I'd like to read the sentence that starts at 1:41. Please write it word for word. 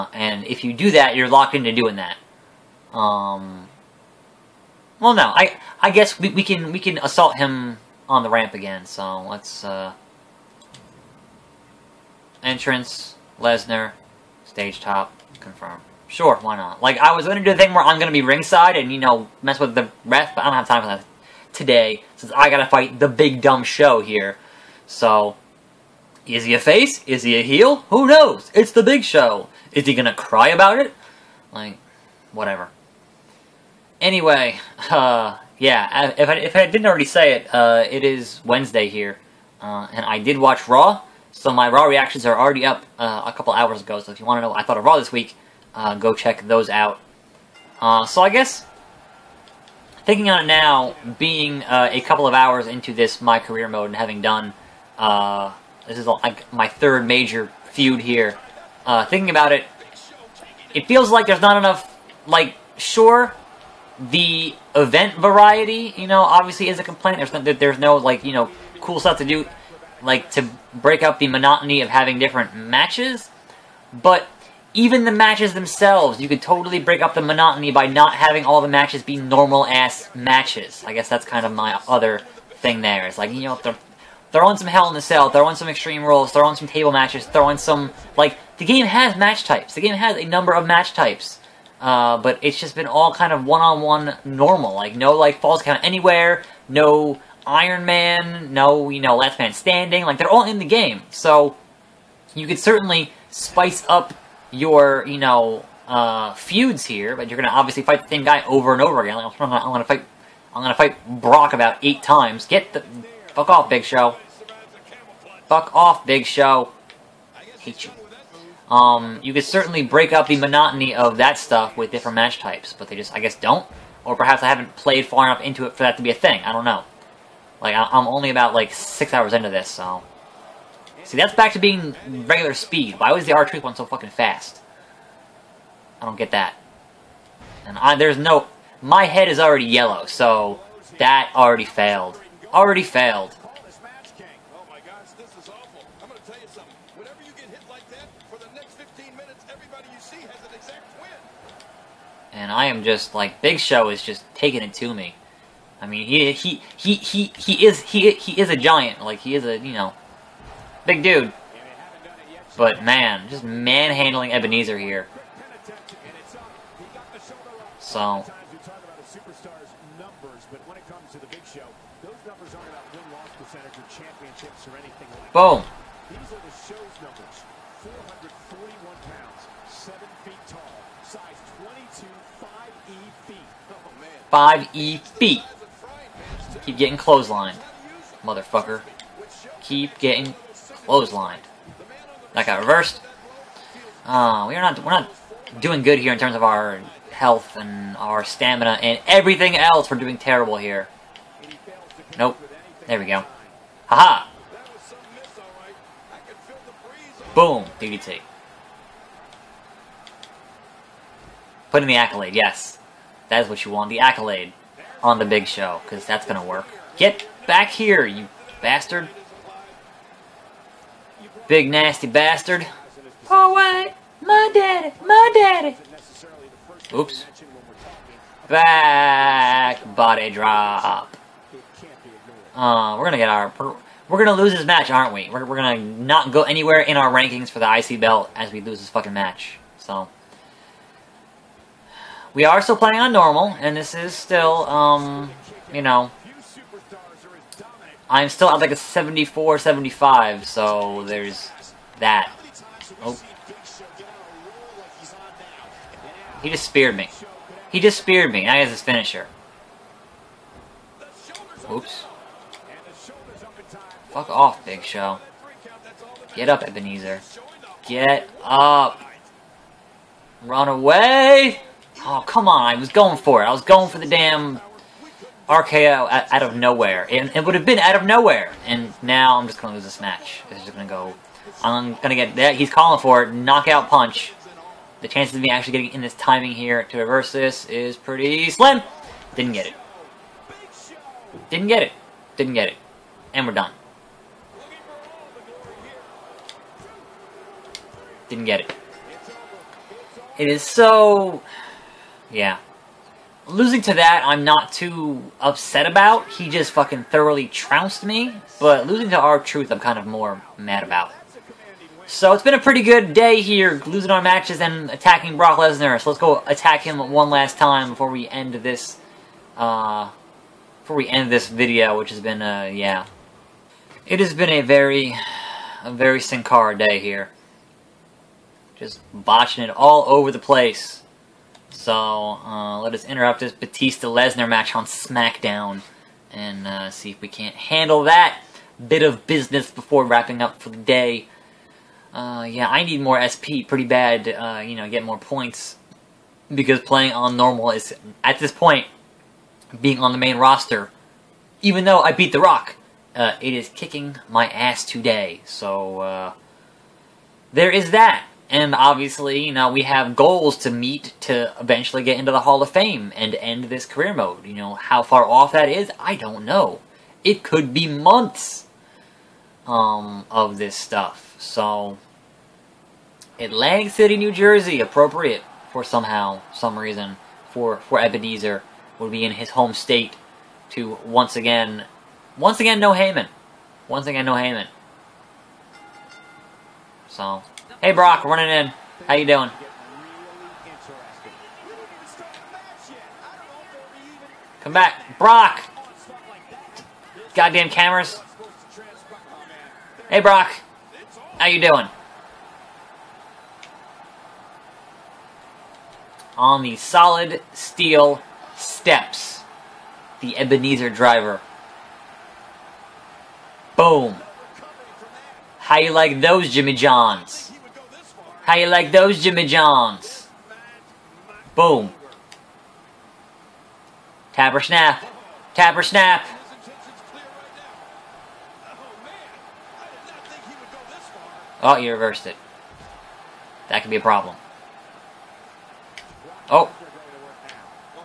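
So, you could certainly spice up your, you know, uh, feuds here.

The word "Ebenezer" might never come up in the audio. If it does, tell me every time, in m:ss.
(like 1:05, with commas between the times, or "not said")
4:26, 6:18, 6:50.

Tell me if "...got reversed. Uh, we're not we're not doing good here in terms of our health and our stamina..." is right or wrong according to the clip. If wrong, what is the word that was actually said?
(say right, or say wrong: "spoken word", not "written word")
right.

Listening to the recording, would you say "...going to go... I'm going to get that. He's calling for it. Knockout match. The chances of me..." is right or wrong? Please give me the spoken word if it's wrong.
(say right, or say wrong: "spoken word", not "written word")
wrong: "punch", not "match".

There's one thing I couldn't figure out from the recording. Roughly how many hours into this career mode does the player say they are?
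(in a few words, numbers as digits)
6.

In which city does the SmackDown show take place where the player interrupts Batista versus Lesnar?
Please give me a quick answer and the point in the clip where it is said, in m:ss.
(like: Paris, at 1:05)
Atlantic City, at 6:13.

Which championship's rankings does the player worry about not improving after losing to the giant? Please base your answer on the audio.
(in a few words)
IC belt.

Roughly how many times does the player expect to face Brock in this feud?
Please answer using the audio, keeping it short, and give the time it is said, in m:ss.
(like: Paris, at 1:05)
8, at 1:51.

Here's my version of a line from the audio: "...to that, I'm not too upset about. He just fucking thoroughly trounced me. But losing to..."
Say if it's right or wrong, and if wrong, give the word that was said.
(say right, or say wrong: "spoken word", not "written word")
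right.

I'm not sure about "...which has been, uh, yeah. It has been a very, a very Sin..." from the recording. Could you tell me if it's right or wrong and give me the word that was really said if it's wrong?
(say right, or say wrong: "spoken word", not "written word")
right.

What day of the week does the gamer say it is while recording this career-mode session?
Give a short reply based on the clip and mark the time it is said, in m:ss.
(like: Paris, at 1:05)
Wednesday, at 0:38.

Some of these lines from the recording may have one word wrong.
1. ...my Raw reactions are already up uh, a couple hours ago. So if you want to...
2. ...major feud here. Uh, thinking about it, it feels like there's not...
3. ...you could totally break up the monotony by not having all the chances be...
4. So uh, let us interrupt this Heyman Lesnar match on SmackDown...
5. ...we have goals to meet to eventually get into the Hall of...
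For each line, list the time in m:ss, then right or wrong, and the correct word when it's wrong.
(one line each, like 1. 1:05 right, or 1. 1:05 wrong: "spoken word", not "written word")
1. 0:41 right
2. 0:57 right
3. 1:16 wrong: "matches", not "chances"
4. 5:31 wrong: "Batista", not "Heyman"
5. 5:59 right.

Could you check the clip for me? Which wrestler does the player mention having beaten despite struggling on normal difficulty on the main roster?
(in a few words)
The Rock.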